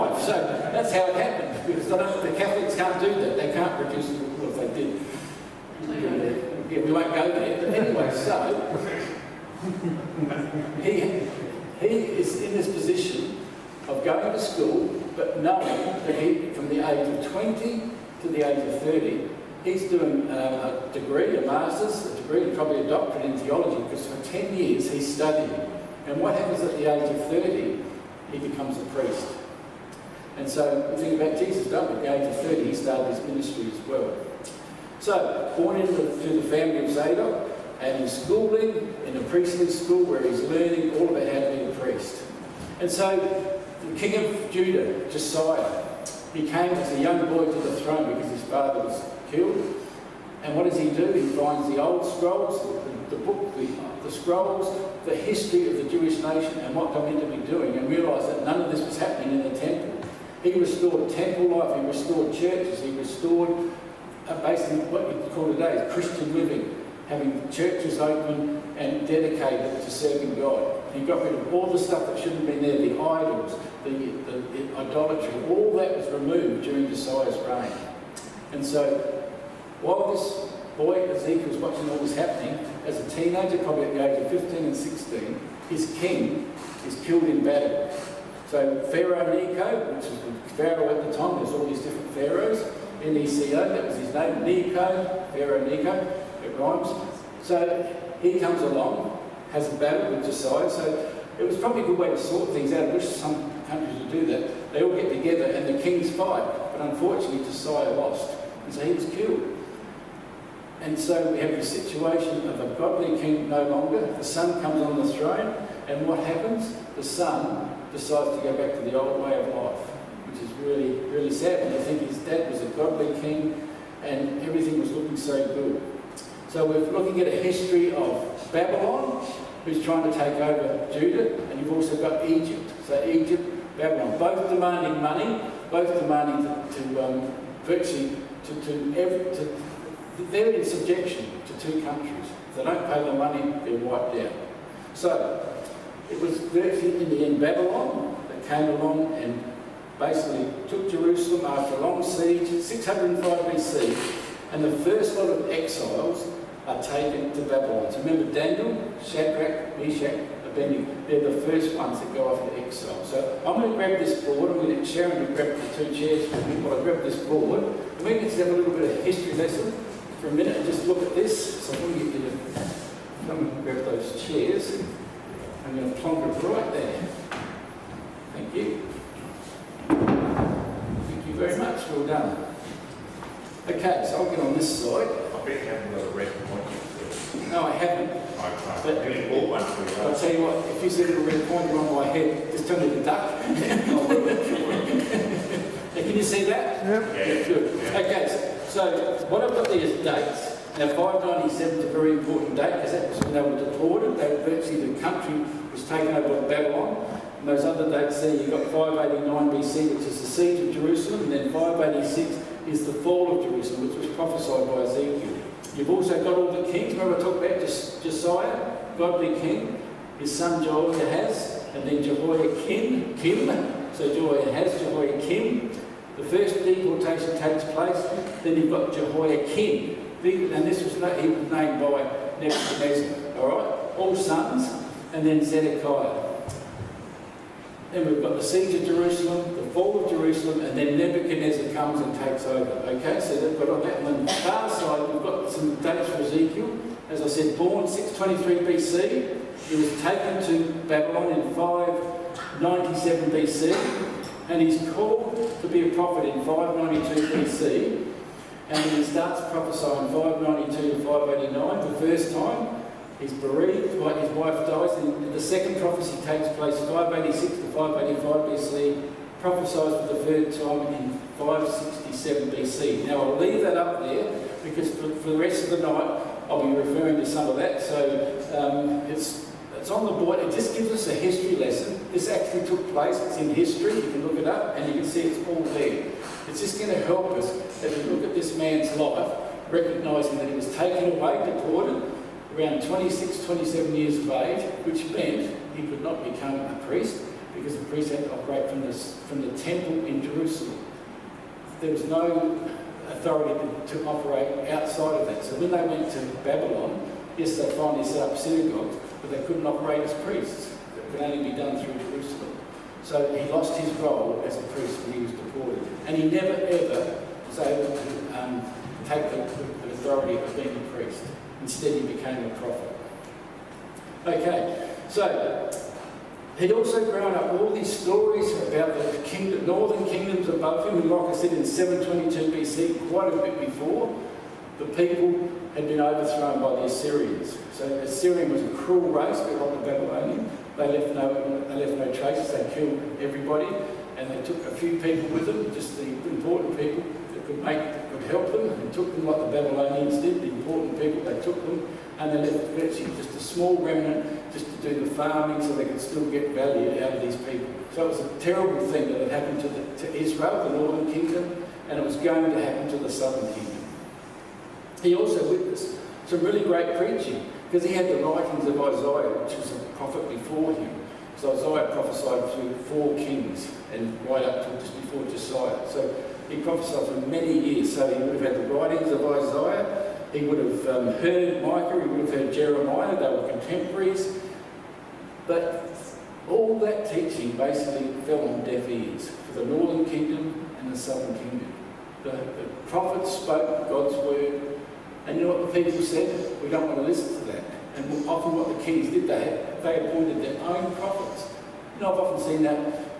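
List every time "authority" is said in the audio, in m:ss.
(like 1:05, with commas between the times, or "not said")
5:03, 5:19.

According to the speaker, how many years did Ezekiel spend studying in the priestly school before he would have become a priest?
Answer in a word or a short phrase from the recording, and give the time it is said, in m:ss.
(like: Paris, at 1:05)
10, at 0:24.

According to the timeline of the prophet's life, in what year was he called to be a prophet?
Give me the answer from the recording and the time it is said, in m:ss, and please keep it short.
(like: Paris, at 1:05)
592 BC, at 4:16.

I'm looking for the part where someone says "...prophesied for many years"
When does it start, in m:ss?
6:16.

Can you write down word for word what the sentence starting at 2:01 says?
And I think his dad was a godly king, and everything was looking so good.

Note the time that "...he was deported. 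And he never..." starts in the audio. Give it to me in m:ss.
5:15.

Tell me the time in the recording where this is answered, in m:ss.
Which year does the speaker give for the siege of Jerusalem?
3:28.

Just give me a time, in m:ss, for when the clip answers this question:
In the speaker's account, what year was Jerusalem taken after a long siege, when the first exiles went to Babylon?
2:32.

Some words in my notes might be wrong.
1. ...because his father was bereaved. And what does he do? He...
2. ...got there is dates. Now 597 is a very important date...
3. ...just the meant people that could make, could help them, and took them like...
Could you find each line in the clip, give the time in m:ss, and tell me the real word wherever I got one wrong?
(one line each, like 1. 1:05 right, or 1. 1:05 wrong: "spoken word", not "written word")
1. 0:48 wrong: "killed", not "bereaved"
2. 3:19 right
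3. 5:45 wrong: "important", not "meant".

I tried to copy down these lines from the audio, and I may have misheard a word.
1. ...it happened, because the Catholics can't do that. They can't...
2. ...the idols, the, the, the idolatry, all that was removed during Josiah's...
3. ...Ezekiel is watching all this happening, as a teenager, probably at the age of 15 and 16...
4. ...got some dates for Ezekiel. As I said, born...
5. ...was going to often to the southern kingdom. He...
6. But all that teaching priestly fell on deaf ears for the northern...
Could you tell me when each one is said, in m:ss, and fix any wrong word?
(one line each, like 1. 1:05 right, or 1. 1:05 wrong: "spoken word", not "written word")
1. 0:01 right
2. 1:12 right
3. 1:21 right
4. 4:05 right
5. 6:02 wrong: "happen", not "often"
6. 6:25 wrong: "basically", not "priestly".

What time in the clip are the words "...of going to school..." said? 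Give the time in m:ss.
0:13.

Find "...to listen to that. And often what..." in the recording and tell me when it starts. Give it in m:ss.
6:36.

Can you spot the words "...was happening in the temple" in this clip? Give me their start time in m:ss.
0:58.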